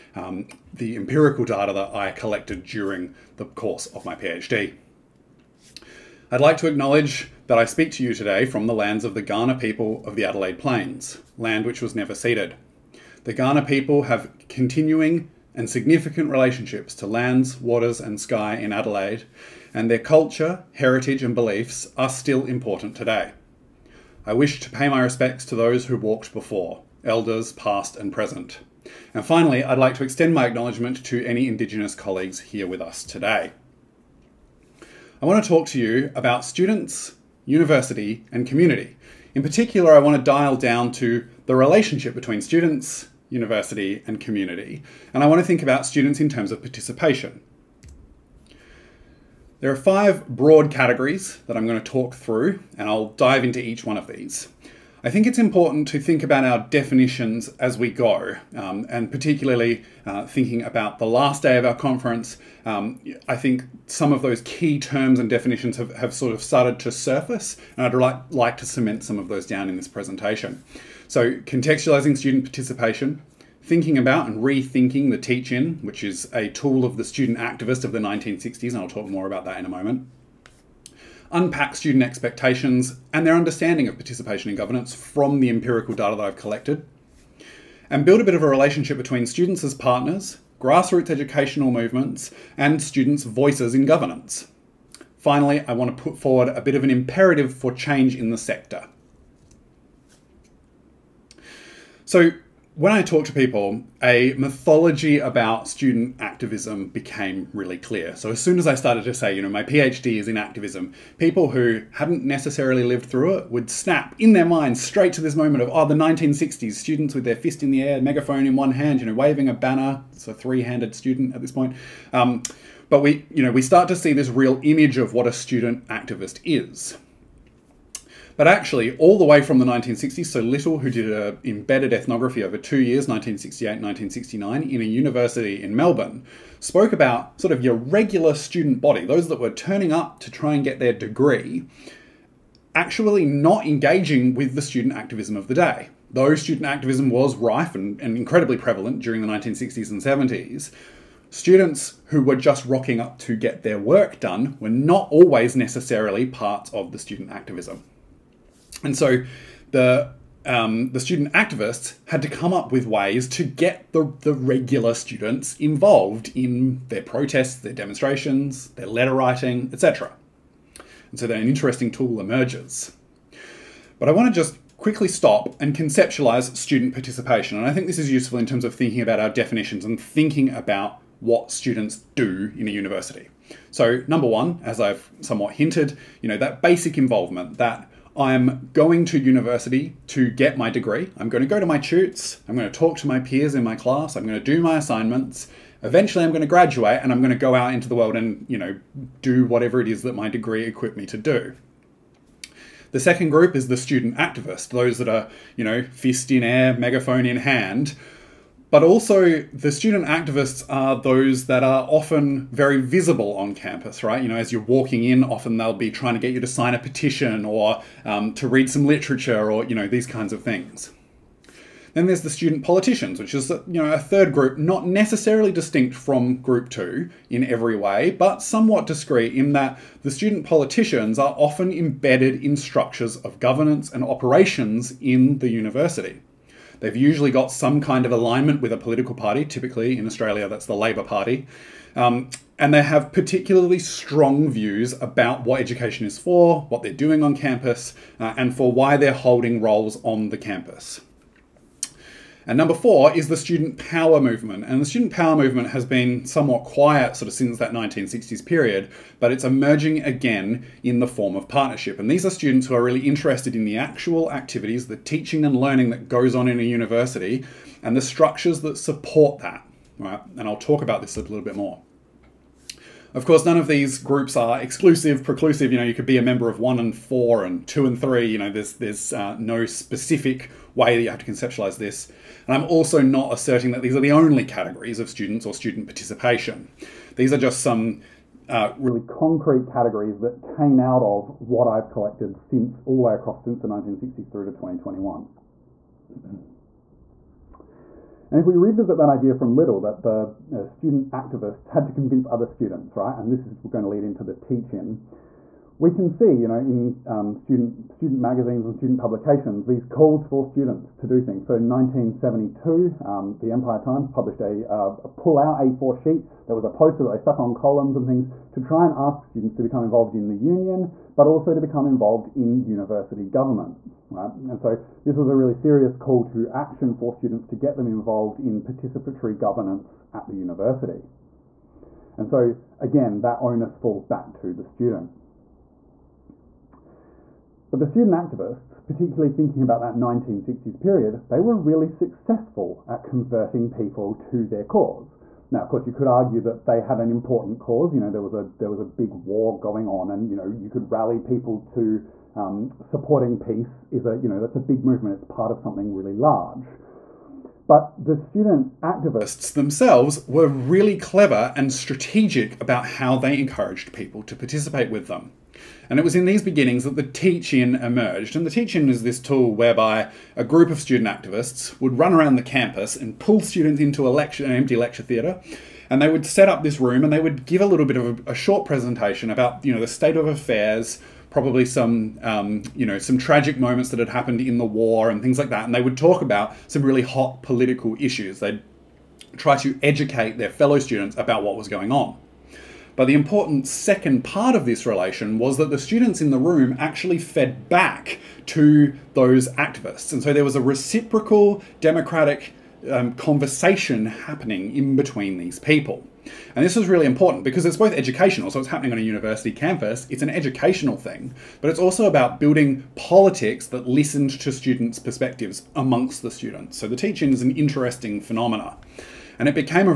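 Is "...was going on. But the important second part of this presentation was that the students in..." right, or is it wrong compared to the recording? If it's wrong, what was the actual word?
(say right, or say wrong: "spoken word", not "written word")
wrong: "relation", not "presentation".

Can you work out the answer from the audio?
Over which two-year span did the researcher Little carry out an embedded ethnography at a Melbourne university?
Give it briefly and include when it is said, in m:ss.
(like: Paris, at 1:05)
1968-1969, at 2:13.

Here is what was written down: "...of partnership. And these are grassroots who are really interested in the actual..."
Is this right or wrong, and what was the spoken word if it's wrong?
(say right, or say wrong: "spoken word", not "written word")
wrong: "students", not "grassroots".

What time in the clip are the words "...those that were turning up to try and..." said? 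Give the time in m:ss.
2:19.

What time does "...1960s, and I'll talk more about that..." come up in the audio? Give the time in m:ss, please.
1:17.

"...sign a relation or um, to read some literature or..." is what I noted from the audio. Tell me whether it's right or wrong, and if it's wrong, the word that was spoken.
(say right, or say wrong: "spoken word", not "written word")
wrong: "petition", not "relation".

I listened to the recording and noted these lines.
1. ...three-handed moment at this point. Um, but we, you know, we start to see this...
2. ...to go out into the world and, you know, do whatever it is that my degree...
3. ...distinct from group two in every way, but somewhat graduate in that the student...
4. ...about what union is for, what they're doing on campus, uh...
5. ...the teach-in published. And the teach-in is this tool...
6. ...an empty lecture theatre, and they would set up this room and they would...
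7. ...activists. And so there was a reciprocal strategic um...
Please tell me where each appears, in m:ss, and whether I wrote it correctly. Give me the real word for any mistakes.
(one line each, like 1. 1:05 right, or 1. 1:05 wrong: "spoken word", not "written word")
1. 2:00 wrong: "student", not "moment"
2. 3:17 right
3. 3:45 wrong: "discrete", not "graduate"
4. 4:05 wrong: "education", not "union"
5. 6:06 wrong: "emerged", not "published"
6. 6:14 right
7. 6:39 wrong: "democratic", not "strategic".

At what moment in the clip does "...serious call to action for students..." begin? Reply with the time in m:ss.
5:25.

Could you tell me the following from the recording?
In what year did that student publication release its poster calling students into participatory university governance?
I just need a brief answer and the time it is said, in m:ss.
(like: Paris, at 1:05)
1972, at 5:11.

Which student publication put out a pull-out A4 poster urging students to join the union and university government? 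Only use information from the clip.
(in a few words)
Empire Times.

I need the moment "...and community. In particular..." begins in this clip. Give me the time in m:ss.
0:38.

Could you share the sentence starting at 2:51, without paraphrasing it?
And so then an interesting tool emerges.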